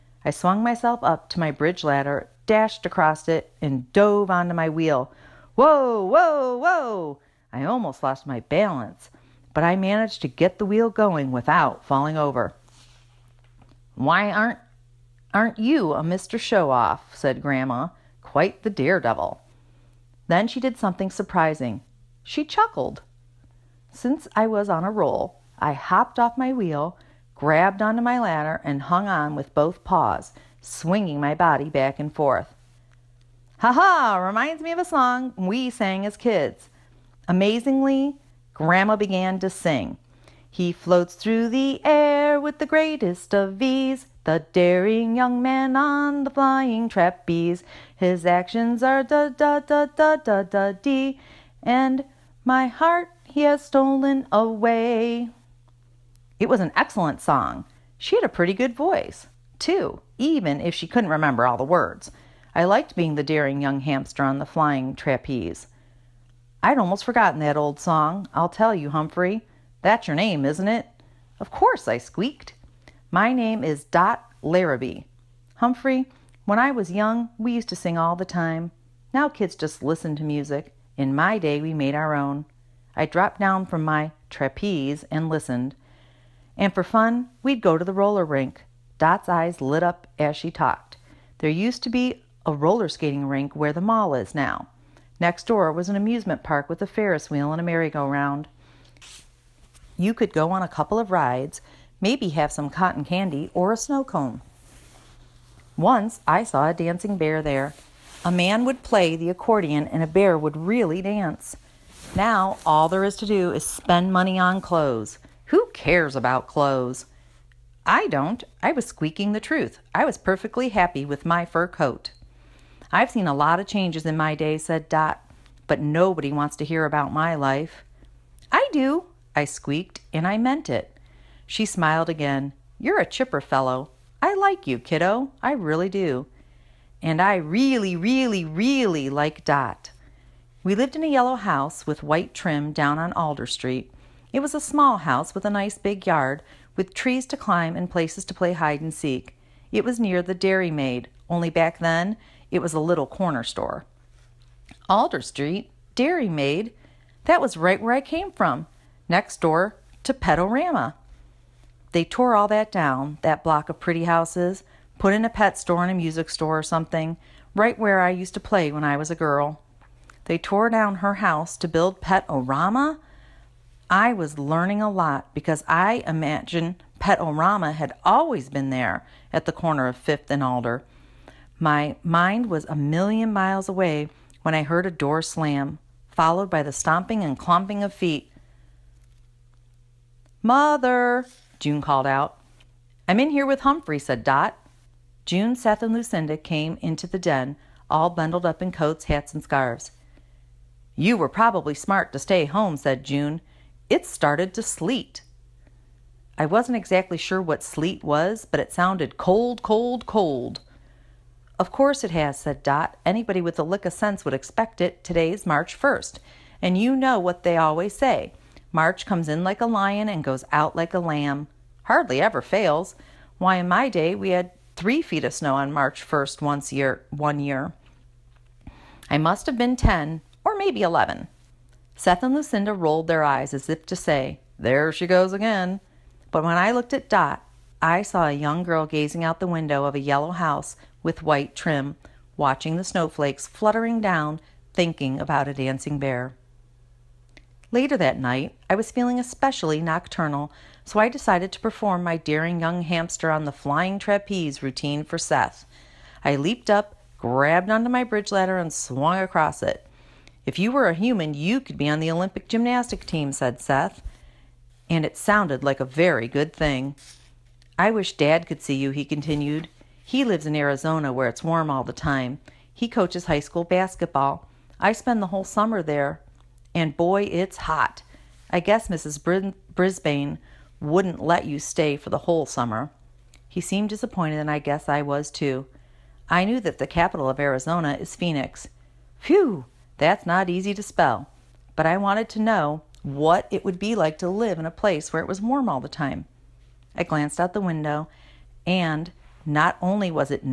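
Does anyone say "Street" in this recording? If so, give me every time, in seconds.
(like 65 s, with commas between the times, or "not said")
143 s, 155 s.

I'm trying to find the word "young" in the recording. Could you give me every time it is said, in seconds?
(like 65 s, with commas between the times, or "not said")
45 s, 63 s, 76 s, 238 s, 252 s.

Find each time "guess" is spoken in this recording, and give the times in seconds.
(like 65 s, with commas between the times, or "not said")
278 s, 284 s.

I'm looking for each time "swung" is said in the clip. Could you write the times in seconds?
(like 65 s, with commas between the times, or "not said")
0 s, 258 s.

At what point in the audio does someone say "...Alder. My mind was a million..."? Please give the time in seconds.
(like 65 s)
180 s.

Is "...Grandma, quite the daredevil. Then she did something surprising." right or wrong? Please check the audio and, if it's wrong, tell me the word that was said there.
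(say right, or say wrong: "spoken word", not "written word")
right.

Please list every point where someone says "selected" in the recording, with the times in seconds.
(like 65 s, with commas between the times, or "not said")
not said.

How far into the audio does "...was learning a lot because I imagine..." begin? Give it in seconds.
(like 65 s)
174 s.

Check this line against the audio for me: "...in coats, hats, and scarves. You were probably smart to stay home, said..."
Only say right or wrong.
right.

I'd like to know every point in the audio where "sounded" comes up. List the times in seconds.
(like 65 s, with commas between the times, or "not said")
208 s, 265 s.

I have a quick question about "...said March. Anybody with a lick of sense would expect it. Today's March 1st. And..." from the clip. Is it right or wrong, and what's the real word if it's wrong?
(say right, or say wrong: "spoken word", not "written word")
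wrong: "Dot", not "March".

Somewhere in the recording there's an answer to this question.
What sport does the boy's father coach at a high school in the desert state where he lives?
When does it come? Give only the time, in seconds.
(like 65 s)
273 s.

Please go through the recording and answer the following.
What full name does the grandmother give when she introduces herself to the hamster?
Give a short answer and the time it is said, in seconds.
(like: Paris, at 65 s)
Dot Larrabee, at 73 s.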